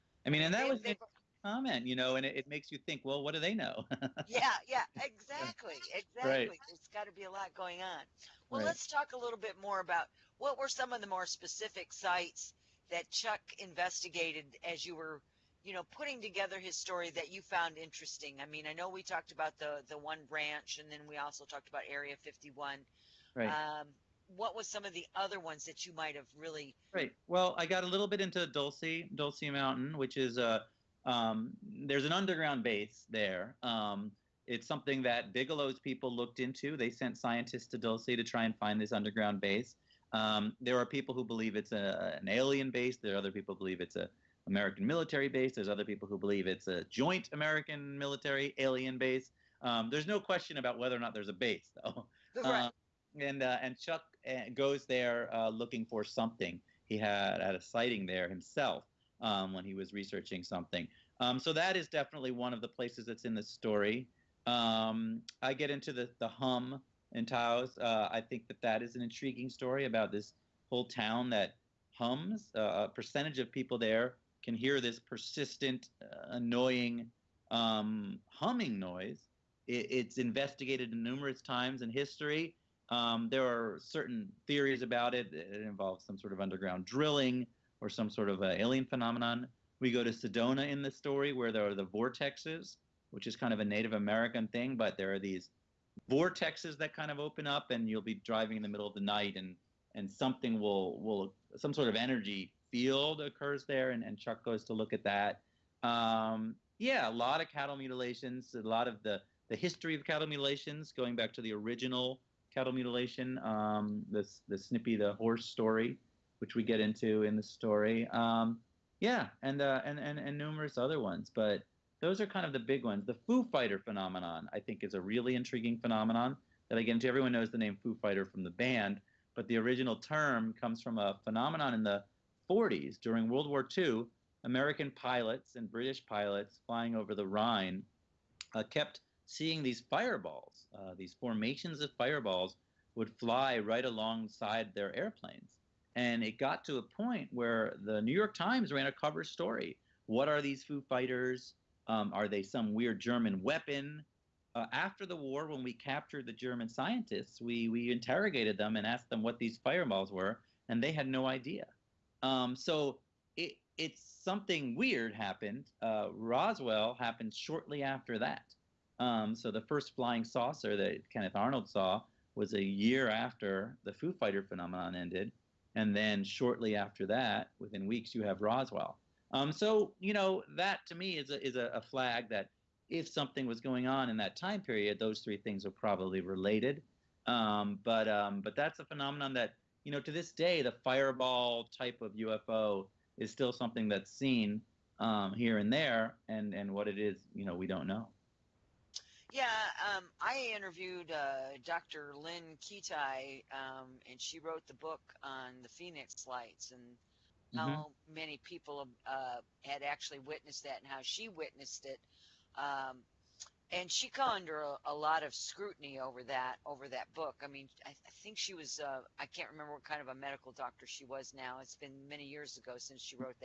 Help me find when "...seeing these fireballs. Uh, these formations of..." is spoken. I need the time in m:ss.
2:19.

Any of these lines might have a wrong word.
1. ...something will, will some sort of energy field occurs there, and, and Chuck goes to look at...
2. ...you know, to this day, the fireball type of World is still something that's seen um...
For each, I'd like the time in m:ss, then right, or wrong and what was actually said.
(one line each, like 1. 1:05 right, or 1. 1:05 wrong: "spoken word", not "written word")
1. 1:40 right
2. 3:09 wrong: "UFO", not "World".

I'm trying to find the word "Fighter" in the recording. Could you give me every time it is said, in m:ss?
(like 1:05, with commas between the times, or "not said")
2:03, 2:07, 2:30, 2:54.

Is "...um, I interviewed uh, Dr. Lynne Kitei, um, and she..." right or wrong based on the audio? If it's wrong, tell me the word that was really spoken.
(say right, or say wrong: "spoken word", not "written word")
right.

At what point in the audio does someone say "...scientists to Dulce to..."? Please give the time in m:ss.
0:37.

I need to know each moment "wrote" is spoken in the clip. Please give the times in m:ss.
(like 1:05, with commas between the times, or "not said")
3:24.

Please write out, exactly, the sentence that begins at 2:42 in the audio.
Um, so it it's something weird happened.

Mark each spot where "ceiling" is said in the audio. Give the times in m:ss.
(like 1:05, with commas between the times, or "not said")
not said.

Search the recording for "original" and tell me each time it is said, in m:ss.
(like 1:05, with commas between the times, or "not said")
1:51, 2:09.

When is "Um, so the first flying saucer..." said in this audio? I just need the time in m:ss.
2:48.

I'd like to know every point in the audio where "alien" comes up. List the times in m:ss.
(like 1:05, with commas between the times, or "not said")
0:42, 0:48, 1:28.